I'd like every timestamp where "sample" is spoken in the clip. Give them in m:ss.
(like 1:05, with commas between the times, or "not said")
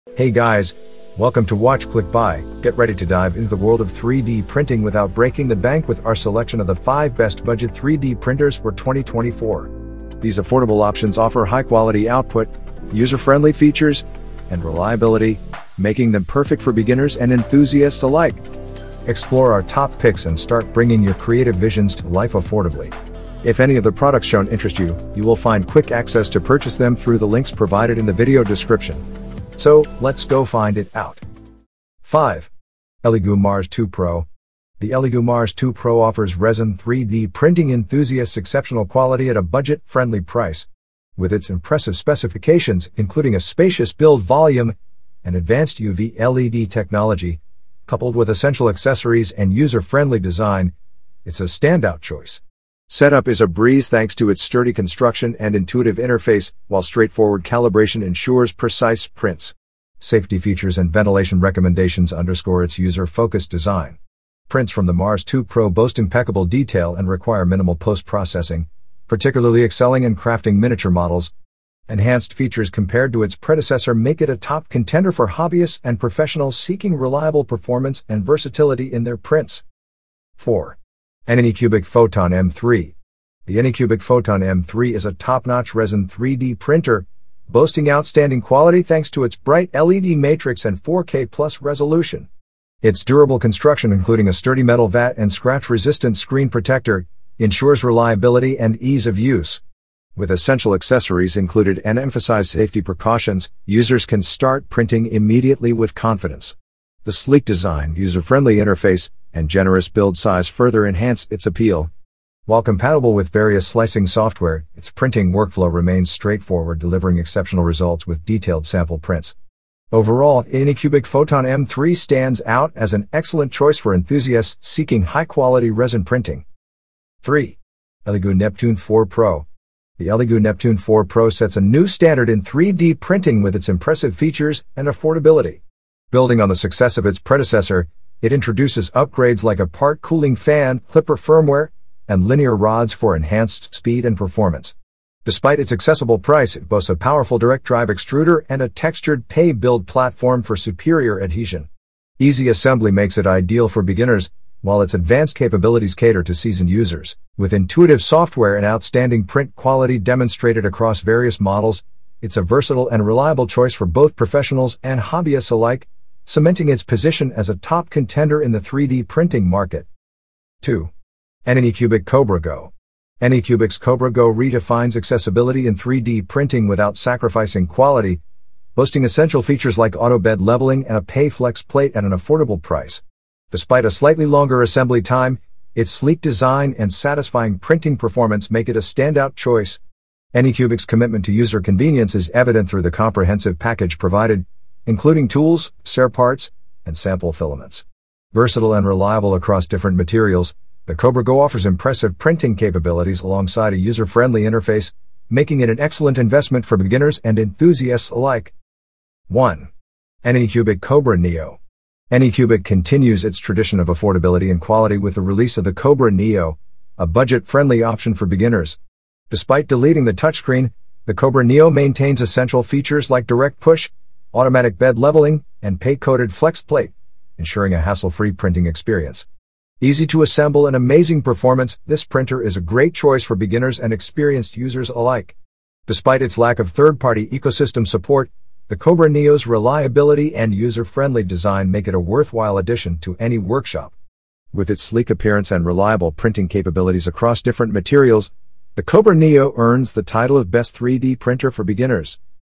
1:58, 3:16.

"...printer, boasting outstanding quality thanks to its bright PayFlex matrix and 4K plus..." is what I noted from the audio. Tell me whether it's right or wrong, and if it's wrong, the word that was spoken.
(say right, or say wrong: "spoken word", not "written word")
wrong: "LED", not "PayFlex".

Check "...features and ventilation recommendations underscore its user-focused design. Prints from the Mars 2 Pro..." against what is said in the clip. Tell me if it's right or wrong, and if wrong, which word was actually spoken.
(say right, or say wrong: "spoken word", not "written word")
right.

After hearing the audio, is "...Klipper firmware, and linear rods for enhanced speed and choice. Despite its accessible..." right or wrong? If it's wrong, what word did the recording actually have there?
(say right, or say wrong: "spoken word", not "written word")
wrong: "performance", not "choice".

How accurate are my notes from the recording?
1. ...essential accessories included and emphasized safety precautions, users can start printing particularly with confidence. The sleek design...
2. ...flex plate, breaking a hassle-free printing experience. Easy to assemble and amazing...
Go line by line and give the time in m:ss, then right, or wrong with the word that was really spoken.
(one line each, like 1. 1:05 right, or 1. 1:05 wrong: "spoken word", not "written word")
1. 1:40 wrong: "immediately", not "particularly"
2. 3:46 wrong: "ensuring", not "breaking".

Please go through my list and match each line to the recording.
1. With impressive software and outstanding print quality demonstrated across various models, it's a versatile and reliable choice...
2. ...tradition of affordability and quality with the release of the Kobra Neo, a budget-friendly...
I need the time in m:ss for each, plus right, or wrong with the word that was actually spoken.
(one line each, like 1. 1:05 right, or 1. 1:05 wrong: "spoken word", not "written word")
1. 2:37 wrong: "intuitive", not "impressive"
2. 3:33 right.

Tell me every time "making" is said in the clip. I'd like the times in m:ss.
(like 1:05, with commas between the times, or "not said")
0:15, 3:25.